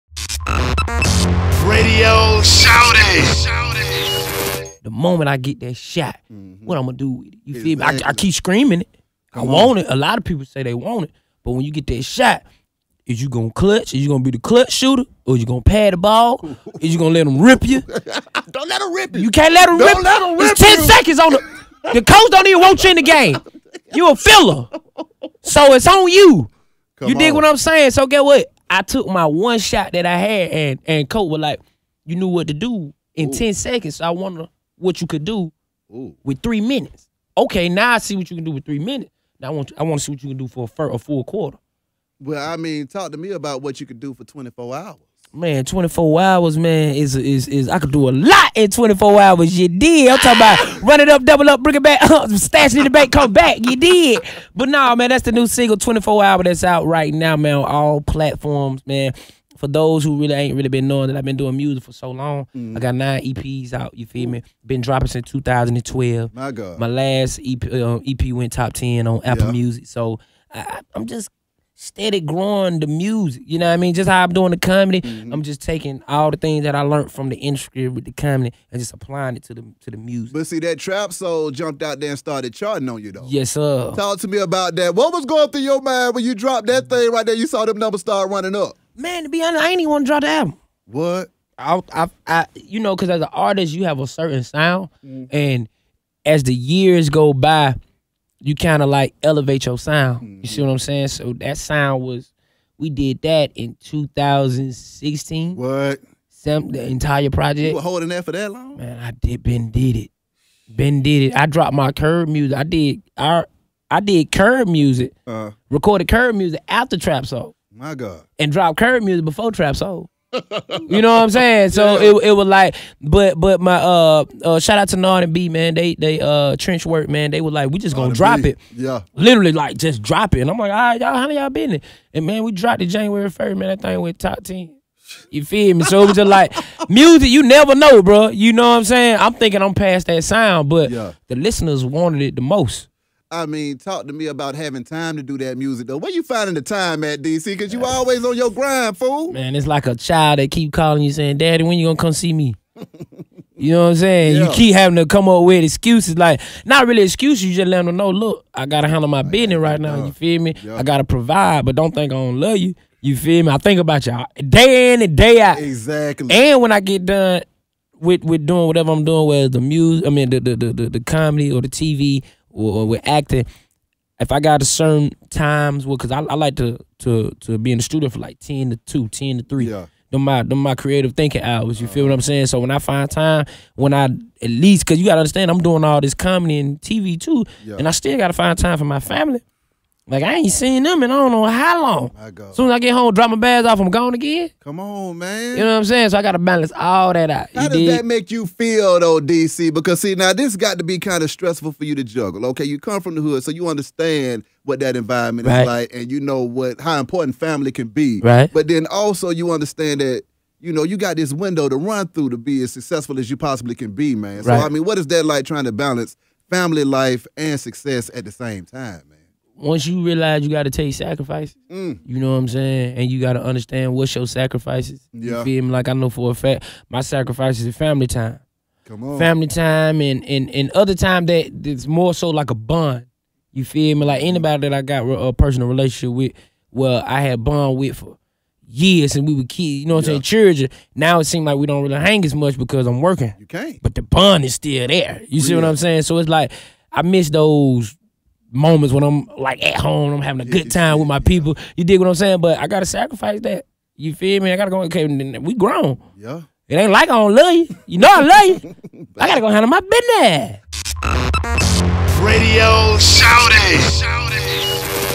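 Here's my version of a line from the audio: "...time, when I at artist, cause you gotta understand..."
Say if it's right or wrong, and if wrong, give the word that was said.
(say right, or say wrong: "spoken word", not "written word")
wrong: "least", not "artist".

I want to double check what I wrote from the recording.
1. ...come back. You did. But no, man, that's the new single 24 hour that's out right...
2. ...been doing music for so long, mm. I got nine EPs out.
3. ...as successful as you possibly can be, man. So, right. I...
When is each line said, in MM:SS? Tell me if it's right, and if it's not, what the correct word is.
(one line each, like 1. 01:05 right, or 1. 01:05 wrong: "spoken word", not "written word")
1. 00:53 right
2. 01:01 right
3. 03:32 right.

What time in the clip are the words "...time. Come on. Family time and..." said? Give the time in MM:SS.
03:48.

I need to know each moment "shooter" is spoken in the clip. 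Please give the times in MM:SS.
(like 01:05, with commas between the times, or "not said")
00:14.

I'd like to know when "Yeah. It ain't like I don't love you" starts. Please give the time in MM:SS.
04:16.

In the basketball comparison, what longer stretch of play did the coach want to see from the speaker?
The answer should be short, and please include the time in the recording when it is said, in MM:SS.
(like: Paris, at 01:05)
a full quarter, at 00:40.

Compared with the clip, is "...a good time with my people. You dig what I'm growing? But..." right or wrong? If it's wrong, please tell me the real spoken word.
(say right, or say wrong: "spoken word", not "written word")
wrong: "saying", not "growing".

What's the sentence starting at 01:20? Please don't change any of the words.
But see, that trap soul jumped out there and started charting on you though.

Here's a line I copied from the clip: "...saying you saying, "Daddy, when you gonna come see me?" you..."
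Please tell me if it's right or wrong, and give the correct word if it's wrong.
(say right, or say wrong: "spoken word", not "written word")
wrong: "calling", not "saying".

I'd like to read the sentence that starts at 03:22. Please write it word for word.
Okay, you come from the hood, so you understand what that environment right.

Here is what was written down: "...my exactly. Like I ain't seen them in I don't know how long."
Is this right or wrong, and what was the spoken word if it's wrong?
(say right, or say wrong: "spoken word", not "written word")
wrong: "family", not "exactly".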